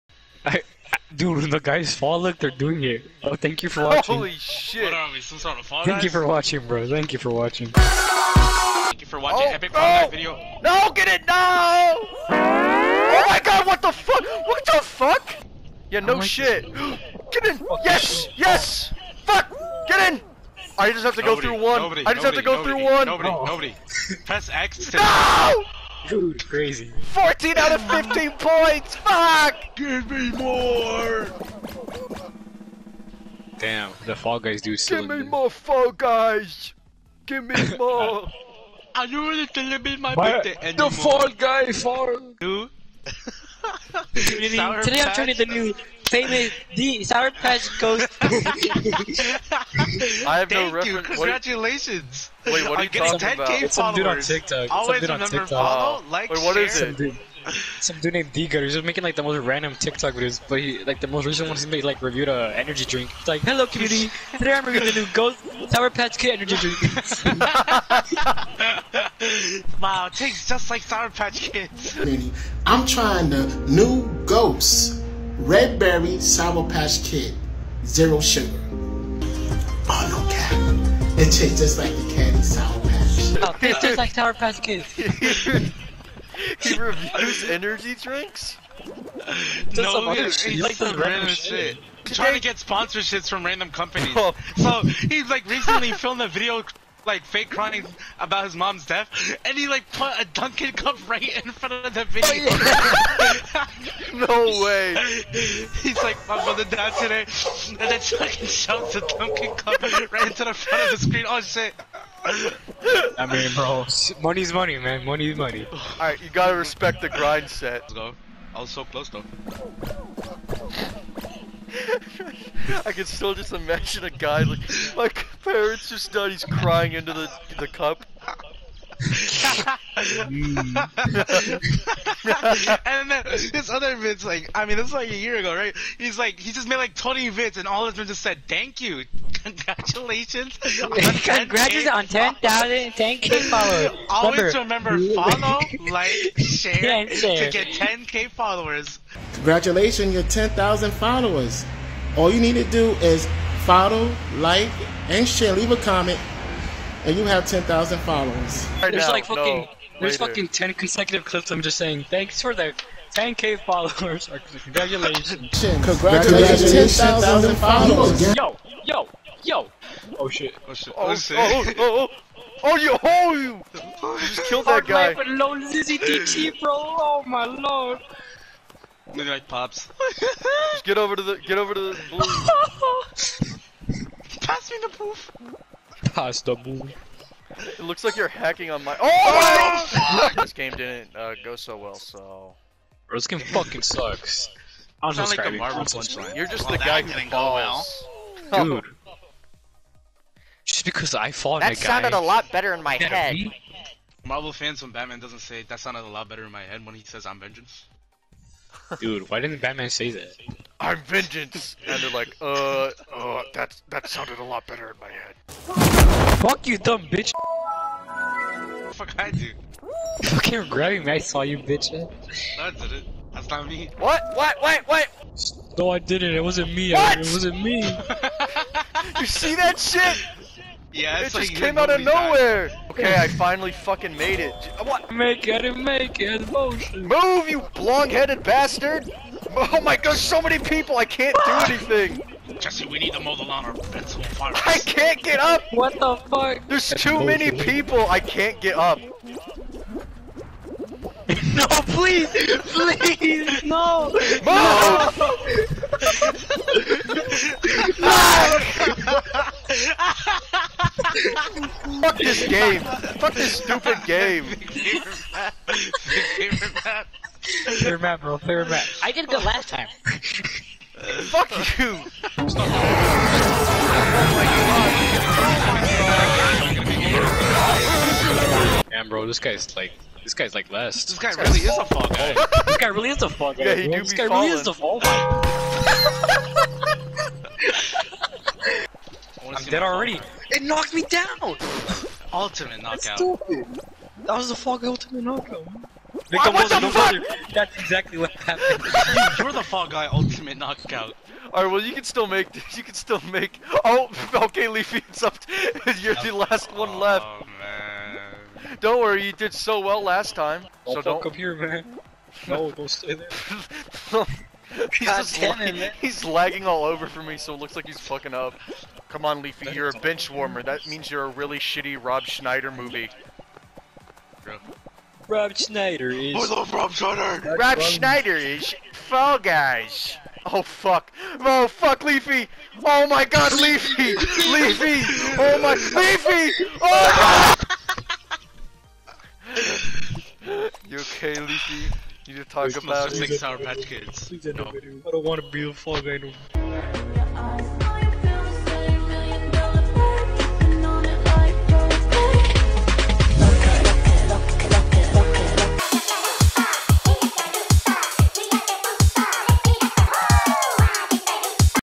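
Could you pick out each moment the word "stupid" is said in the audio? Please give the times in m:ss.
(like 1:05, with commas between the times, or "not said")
4:23, 4:53.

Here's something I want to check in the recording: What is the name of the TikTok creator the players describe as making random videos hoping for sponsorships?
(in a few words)
Digger.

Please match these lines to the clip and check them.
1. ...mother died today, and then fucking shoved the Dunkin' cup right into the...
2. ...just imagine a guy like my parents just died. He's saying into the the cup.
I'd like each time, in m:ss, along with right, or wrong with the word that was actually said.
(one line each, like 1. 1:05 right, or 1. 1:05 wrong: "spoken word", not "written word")
1. 1:46 right
2. 2:03 wrong: "crying", not "saying".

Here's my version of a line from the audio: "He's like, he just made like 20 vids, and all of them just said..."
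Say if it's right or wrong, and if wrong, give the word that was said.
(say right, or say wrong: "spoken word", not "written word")
right.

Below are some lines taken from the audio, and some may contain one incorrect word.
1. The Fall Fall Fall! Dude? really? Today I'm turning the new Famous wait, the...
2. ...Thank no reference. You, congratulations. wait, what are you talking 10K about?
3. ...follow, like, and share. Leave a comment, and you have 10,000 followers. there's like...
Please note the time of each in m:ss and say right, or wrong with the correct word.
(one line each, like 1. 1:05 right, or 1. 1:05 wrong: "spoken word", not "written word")
1. 0:40 wrong: "Guy", not "Fall"
2. 0:50 right
3. 2:33 right.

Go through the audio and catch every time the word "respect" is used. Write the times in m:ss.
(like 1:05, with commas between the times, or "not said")
1:56.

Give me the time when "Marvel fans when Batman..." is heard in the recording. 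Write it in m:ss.
3:24.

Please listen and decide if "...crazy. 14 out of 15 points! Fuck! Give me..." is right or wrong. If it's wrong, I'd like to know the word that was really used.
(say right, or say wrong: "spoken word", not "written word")
right.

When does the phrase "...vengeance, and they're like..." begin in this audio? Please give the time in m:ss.
3:31.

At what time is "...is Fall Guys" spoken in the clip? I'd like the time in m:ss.
5:28.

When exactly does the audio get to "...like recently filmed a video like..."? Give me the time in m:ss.
1:35.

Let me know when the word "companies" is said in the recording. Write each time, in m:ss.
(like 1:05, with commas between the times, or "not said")
1:33.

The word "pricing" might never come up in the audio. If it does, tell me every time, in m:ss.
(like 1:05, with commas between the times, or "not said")
not said.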